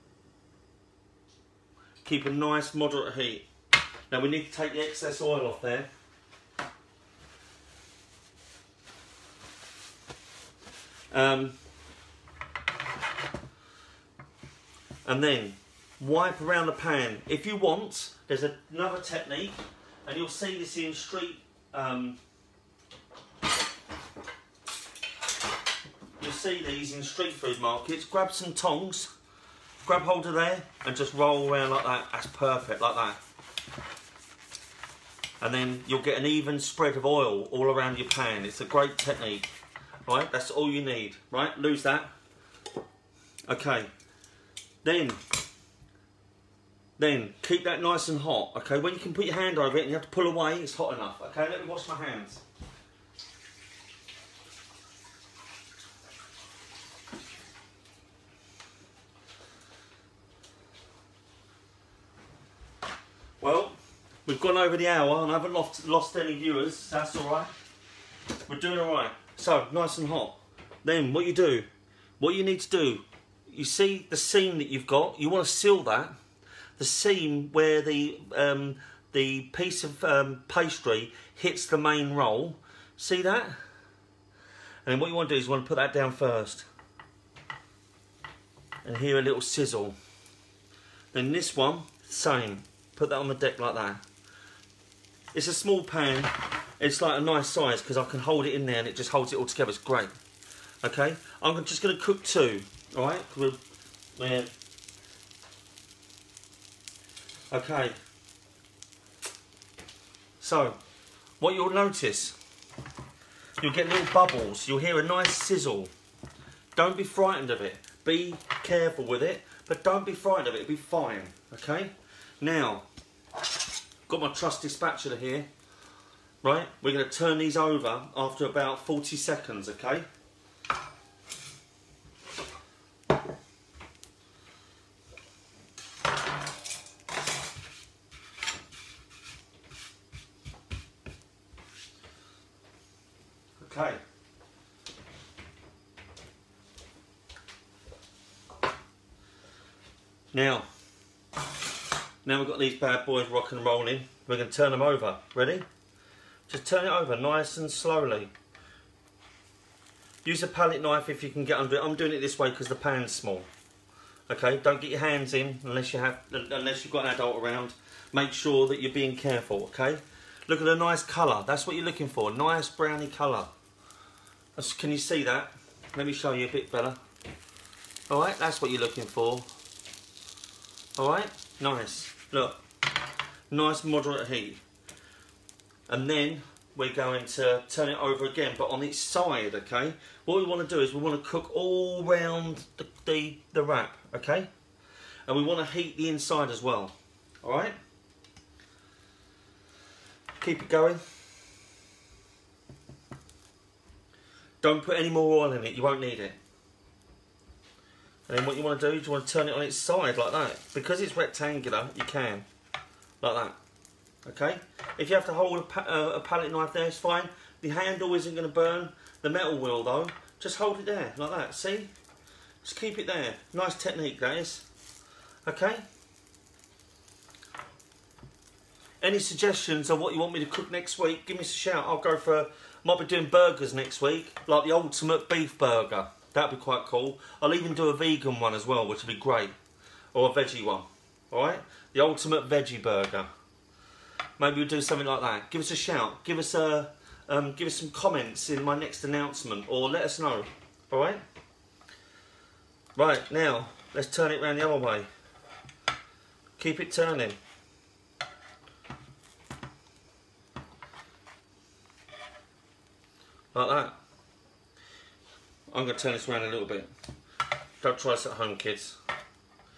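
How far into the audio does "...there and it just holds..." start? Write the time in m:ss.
1:38.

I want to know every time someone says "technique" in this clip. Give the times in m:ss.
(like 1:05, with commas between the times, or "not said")
0:19, 0:38, 3:43.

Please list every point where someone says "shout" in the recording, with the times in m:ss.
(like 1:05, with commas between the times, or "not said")
3:51, 4:05.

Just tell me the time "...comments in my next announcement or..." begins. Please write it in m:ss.
4:07.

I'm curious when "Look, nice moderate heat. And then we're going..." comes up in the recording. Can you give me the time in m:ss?
3:02.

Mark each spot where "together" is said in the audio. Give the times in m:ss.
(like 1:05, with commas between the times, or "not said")
1:39.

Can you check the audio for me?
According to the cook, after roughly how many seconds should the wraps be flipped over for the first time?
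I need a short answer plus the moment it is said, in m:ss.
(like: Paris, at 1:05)
40 seconds, at 2:08.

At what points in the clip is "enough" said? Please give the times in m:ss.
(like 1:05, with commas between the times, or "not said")
0:50.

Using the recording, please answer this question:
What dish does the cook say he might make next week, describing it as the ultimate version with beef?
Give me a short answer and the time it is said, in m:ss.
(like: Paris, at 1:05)
Burgers, at 3:53.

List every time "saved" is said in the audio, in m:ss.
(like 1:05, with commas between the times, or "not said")
not said.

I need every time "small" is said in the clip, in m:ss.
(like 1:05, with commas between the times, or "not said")
1:35, 2:43.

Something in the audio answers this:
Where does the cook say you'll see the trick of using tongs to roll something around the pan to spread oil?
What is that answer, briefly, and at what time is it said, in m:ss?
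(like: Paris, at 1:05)
Street food markets, at 0:27.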